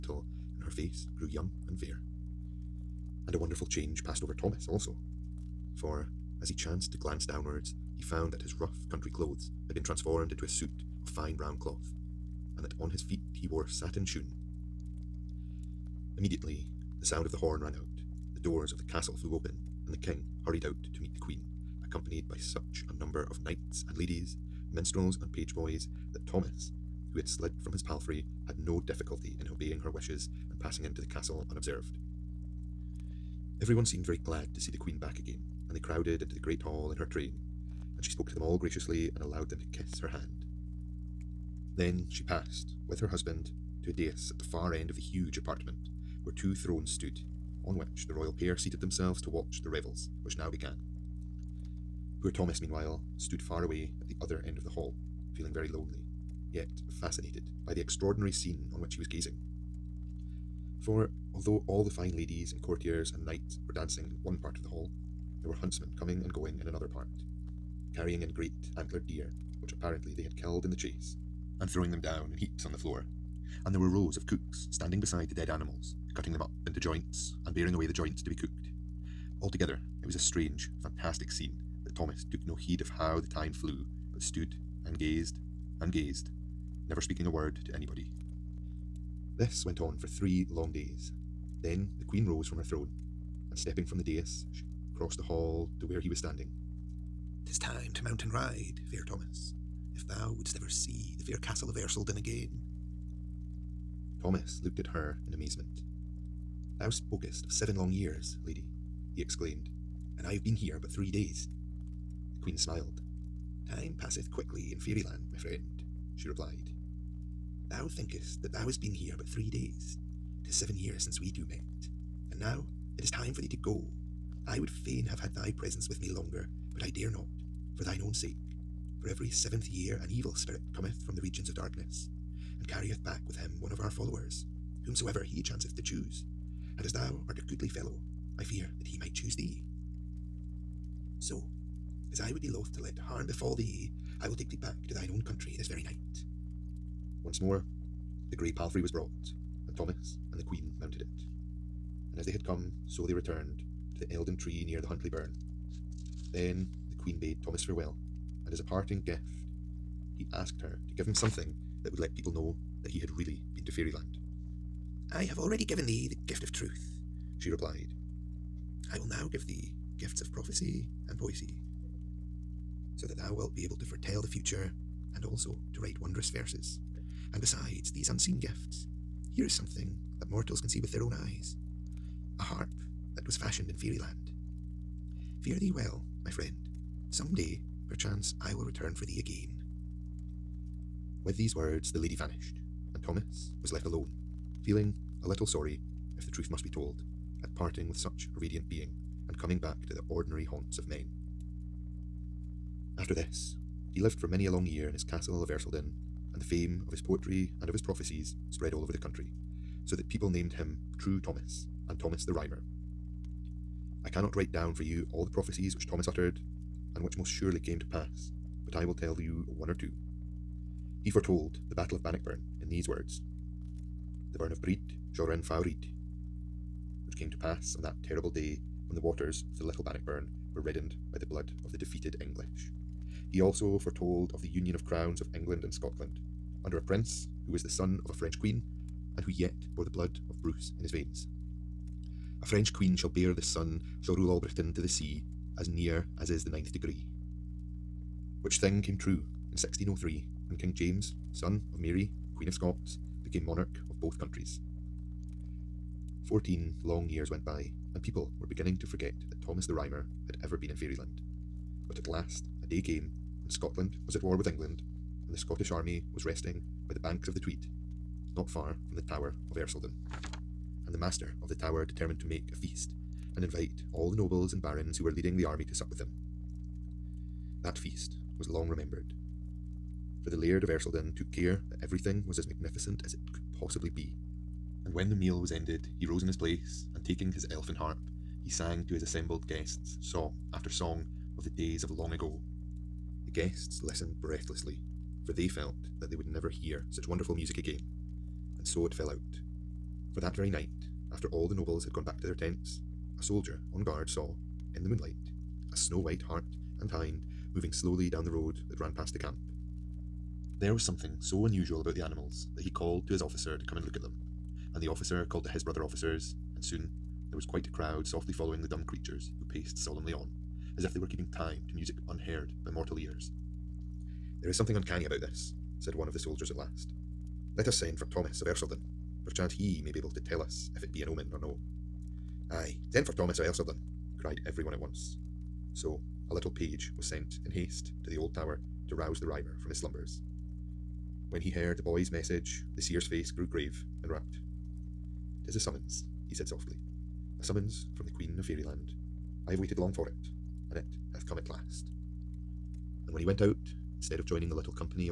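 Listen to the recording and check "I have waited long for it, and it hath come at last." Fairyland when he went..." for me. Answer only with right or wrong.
wrong.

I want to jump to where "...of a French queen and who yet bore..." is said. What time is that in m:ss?
3:58.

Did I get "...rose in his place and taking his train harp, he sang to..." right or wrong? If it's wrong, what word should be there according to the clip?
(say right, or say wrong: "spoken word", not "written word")
wrong: "elfin", not "train".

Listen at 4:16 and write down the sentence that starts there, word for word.
Fourteen long years went by, and people were beginning to forget that Thomas the Rhymer had ever been in fairyland.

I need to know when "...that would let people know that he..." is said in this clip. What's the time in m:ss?
2:41.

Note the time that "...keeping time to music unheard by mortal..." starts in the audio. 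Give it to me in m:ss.
5:21.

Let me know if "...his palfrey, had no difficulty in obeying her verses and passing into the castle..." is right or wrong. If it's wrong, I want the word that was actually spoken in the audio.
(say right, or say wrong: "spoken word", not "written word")
wrong: "wishes", not "verses".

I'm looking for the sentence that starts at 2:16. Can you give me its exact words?
And as thou art a goodly fellow, I fear that he might choose thee.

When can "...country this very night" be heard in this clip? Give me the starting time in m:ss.
2:25.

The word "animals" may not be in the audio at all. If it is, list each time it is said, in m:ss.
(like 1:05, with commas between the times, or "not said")
1:15, 5:12.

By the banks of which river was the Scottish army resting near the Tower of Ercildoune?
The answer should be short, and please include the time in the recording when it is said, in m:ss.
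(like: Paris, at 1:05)
Tweed, at 4:27.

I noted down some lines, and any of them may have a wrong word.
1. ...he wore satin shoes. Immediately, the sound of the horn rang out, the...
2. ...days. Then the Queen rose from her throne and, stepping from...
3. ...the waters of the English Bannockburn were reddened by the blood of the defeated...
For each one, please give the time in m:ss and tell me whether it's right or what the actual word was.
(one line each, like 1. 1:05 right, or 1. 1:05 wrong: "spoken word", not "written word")
1. 0:13 right
2. 1:30 right
3. 3:48 wrong: "Little", not "English".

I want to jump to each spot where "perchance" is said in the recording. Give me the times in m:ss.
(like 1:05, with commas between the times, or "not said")
3:07, 5:29.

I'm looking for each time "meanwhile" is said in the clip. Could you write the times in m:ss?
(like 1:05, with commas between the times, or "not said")
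0:52.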